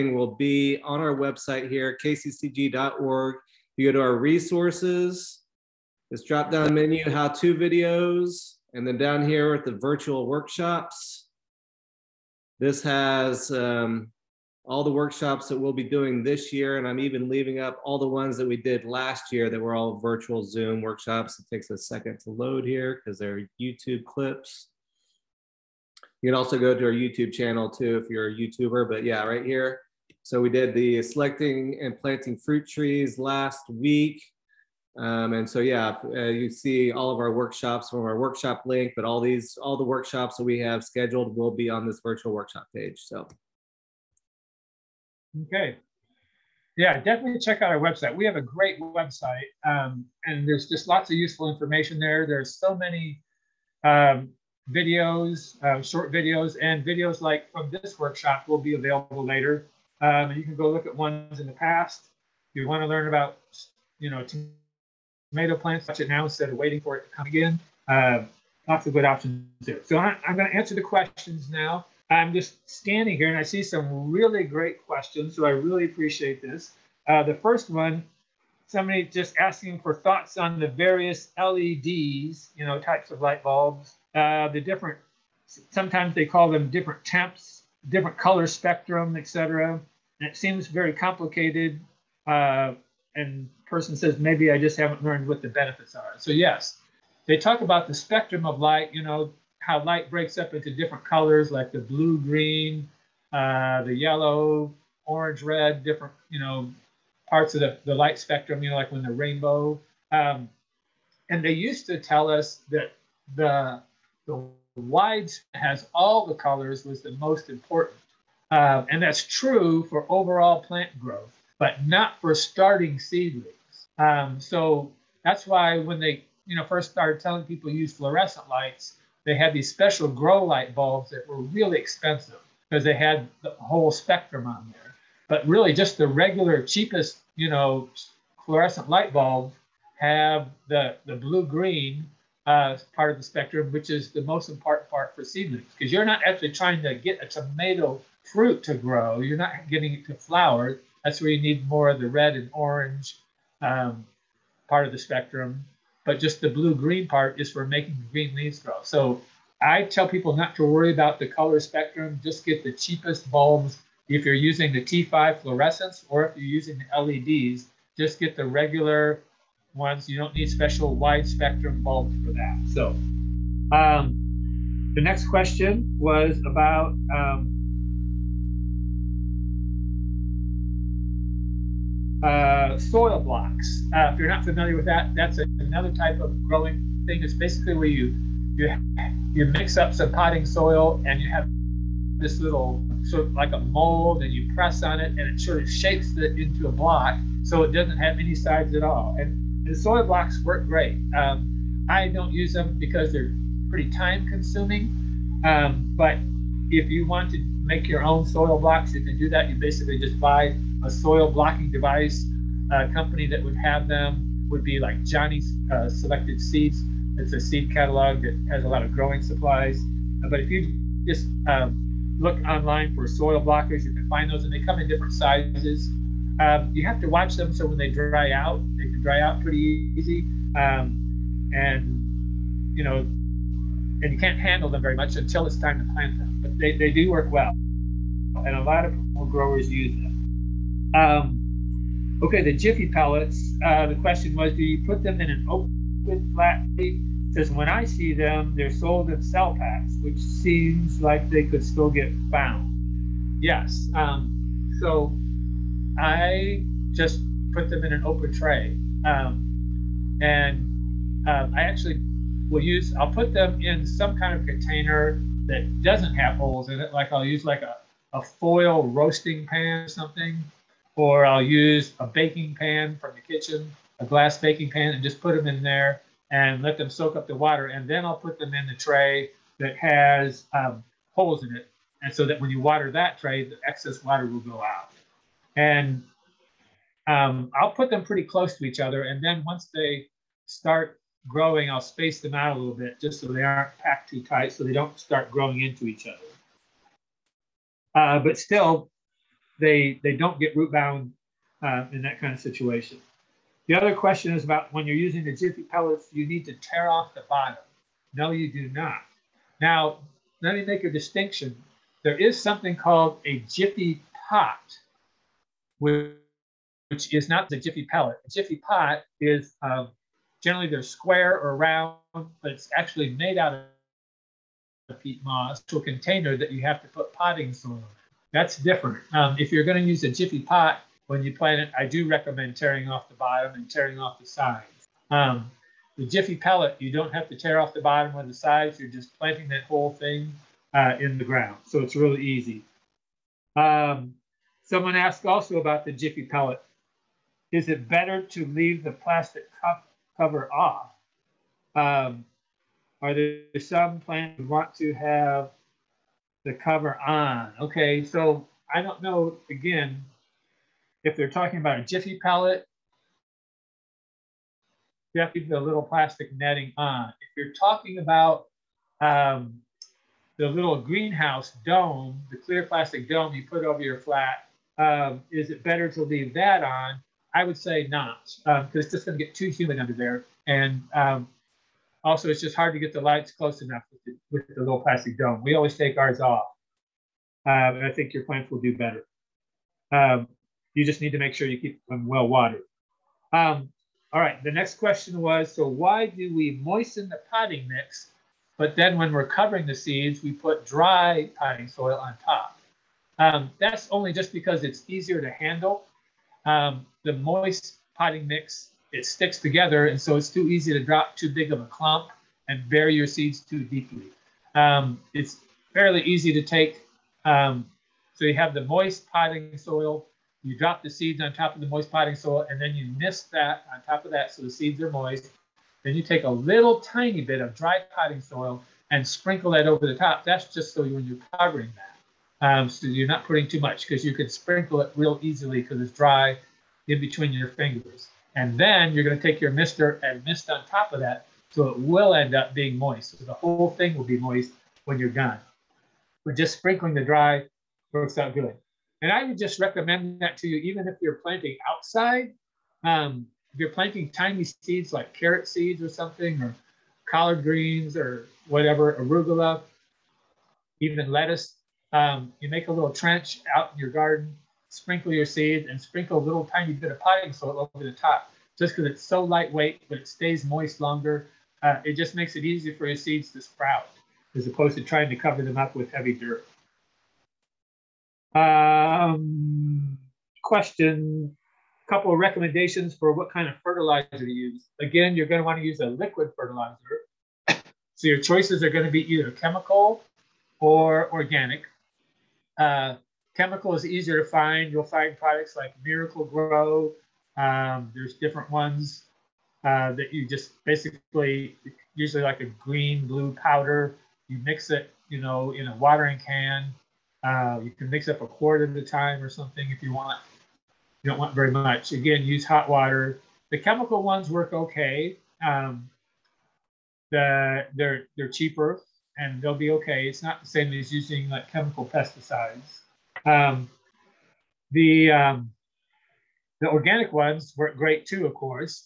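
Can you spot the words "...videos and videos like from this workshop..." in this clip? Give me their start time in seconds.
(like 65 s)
56 s.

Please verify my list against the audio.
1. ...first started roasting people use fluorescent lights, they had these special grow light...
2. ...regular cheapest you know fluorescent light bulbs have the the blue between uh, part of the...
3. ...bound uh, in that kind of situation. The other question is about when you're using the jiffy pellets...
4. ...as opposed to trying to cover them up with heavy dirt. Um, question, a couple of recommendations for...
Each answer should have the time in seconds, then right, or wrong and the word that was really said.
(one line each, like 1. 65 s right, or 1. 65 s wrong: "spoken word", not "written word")
1. 126 s wrong: "telling", not "roasting"
2. 136 s wrong: "green", not "between"
3. 300 s right
4. 474 s right.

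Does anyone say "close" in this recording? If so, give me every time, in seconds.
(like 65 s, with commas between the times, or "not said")
288 s, 383 s.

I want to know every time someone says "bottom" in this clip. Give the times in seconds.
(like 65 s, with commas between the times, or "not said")
307 s, 333 s, 337 s.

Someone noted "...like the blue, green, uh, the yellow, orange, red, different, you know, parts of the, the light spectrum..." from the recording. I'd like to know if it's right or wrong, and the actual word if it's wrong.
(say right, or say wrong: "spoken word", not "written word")
right.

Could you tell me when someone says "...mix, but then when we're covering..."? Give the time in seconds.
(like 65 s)
397 s.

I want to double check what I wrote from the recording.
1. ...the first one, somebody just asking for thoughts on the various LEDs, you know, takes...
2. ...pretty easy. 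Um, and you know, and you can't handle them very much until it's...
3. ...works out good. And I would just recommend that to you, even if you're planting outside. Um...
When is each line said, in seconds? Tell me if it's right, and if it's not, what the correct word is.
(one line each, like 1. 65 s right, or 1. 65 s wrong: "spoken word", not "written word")
1. 77 s wrong: "types", not "takes"
2. 229 s right
3. 447 s right.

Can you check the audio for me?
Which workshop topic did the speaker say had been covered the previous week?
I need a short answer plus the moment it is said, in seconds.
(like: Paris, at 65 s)
Selecting and planting fruit trees, at 31 s.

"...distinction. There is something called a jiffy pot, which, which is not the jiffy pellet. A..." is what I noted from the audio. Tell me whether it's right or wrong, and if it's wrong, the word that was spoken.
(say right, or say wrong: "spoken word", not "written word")
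right.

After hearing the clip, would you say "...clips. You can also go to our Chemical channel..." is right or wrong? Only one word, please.
wrong.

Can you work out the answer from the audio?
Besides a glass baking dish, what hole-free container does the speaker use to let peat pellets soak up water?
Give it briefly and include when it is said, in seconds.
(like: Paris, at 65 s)
A foil roasting pan, at 268 s.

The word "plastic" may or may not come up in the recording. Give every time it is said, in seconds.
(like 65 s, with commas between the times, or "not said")
348 s, 365 s, 372 s, 384 s.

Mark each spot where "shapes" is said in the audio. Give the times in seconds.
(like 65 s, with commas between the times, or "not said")
195 s.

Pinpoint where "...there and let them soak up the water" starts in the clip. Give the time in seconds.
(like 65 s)
275 s.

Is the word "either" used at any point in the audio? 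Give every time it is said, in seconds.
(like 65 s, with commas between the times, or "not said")
489 s.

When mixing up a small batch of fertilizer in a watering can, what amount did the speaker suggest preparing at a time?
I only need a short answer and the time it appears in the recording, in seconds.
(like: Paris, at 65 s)
A quart, at 508 s.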